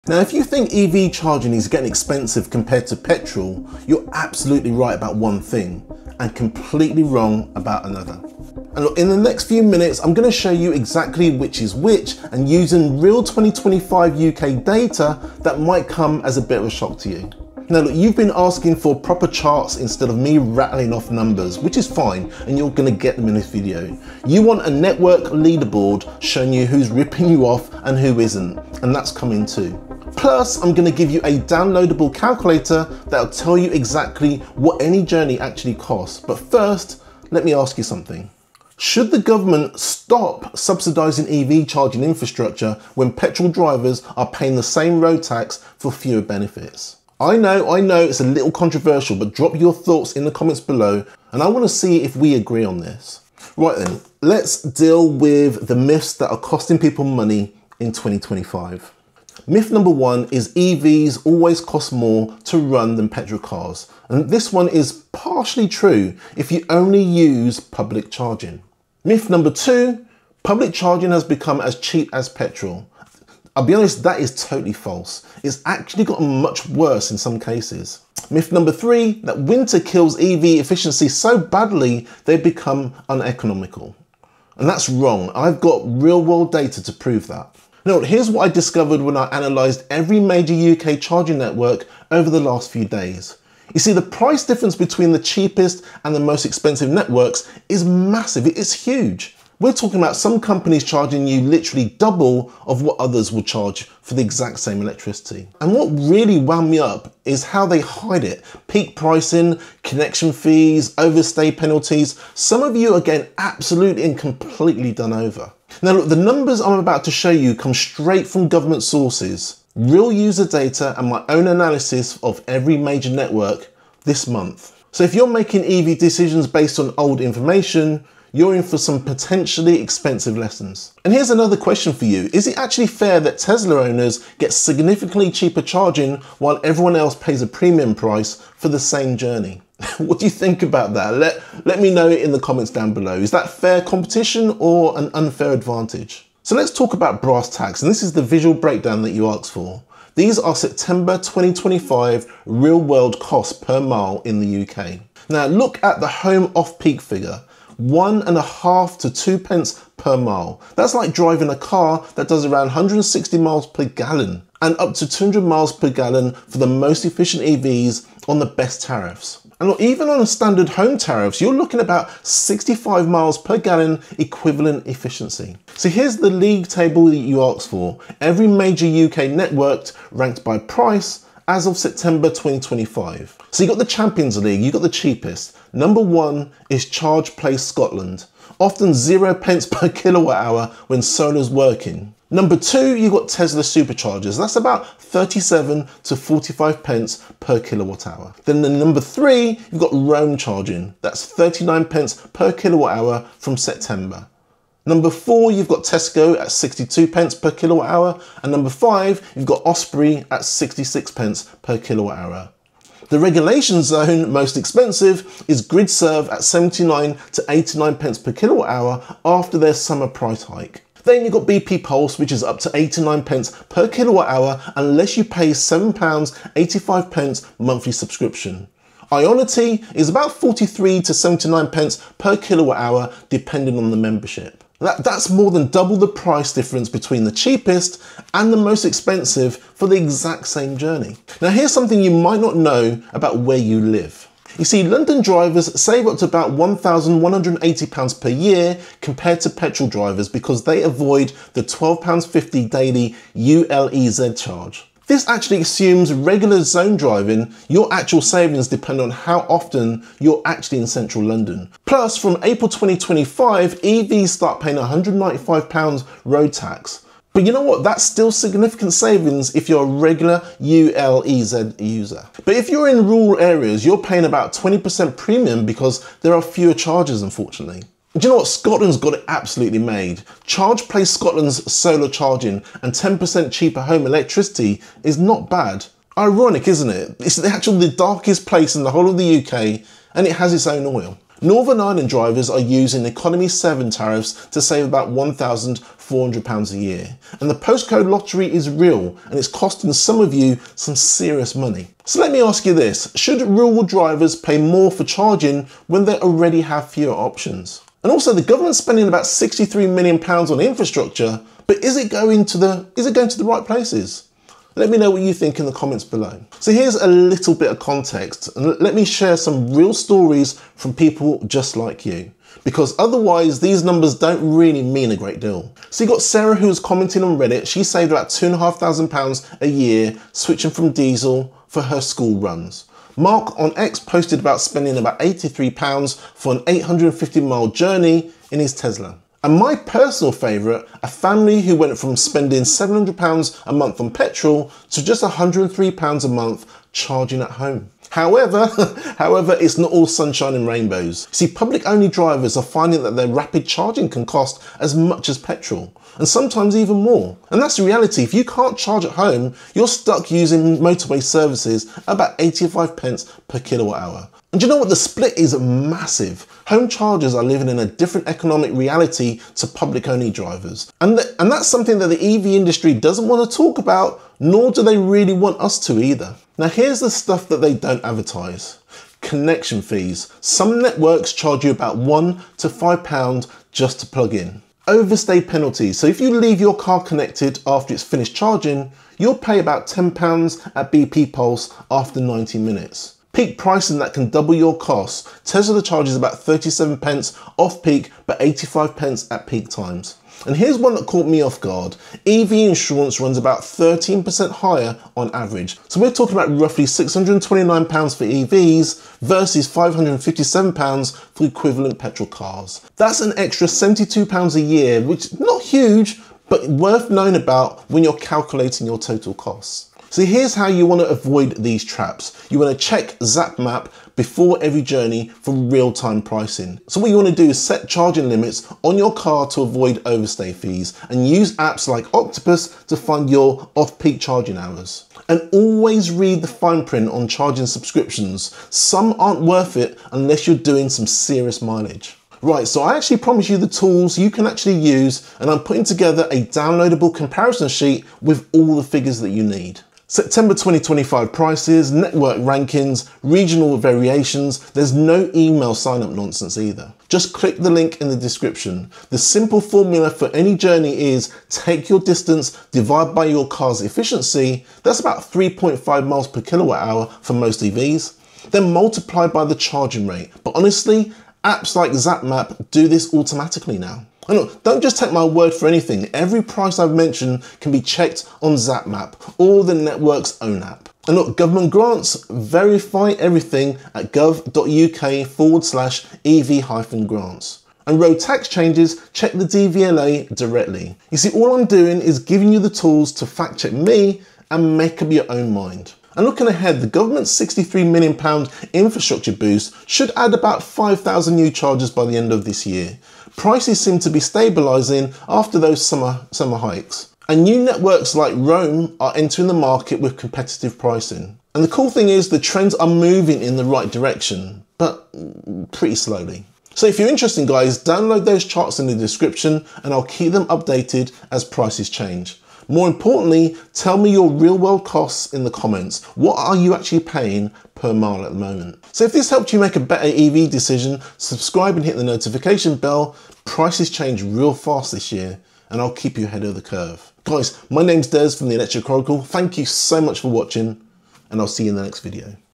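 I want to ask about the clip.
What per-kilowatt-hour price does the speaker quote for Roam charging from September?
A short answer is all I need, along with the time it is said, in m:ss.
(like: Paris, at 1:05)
39p, at 3:21.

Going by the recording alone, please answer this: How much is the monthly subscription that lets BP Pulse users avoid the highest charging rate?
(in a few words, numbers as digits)
£7.85.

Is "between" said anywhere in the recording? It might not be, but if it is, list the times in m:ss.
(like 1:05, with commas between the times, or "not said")
1:34, 3:56.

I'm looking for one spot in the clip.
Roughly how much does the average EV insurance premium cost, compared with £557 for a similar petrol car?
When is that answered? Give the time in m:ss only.
6:46.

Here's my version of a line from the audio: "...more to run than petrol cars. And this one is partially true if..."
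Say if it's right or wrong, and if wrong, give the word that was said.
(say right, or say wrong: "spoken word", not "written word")
right.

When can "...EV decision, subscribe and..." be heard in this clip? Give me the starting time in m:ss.
8:50.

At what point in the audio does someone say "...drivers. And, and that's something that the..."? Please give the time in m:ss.
6:10.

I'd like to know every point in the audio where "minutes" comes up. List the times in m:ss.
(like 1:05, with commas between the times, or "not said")
0:09, 6:32.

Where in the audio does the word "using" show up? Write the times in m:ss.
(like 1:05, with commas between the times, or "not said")
0:12, 4:52, 6:00.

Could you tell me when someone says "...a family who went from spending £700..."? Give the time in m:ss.
5:41.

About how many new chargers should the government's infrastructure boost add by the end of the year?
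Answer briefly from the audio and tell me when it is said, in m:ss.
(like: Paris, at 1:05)
5,000, at 8:20.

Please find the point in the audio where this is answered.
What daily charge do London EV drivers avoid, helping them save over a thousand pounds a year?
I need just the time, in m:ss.
4:11.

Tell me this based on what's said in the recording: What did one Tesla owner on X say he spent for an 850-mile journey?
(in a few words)
83 pounds.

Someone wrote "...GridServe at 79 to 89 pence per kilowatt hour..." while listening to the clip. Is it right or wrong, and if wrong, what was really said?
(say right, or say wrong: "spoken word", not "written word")
right.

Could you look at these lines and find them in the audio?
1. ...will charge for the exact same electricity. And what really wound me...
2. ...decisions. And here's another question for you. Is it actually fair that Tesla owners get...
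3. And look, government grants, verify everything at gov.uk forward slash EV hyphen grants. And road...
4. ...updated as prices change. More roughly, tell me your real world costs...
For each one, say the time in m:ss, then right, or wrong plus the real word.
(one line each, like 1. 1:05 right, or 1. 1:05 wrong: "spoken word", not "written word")
1. 1:43 right
2. 2:10 wrong: "lessons", not "decisions"
3. 8:01 right
4. 8:40 wrong: "importantly", not "roughly".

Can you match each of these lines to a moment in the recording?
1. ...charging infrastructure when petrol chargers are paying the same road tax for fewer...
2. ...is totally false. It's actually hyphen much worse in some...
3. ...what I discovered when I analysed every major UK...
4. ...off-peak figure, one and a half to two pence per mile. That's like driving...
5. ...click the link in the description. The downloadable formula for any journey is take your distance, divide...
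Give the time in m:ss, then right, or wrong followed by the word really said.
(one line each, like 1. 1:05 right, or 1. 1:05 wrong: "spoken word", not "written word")
1. 0:41 wrong: "drivers", not "chargers"
2. 1:14 wrong: "gotten", not "hyphen"
3. 1:28 right
4. 2:36 right
5. 7:37 wrong: "simple", not "downloadable".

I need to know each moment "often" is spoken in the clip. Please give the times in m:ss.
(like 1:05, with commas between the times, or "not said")
3:08, 4:19.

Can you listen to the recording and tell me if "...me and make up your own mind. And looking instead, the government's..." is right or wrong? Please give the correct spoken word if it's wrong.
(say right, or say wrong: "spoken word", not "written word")
wrong: "ahead", not "instead".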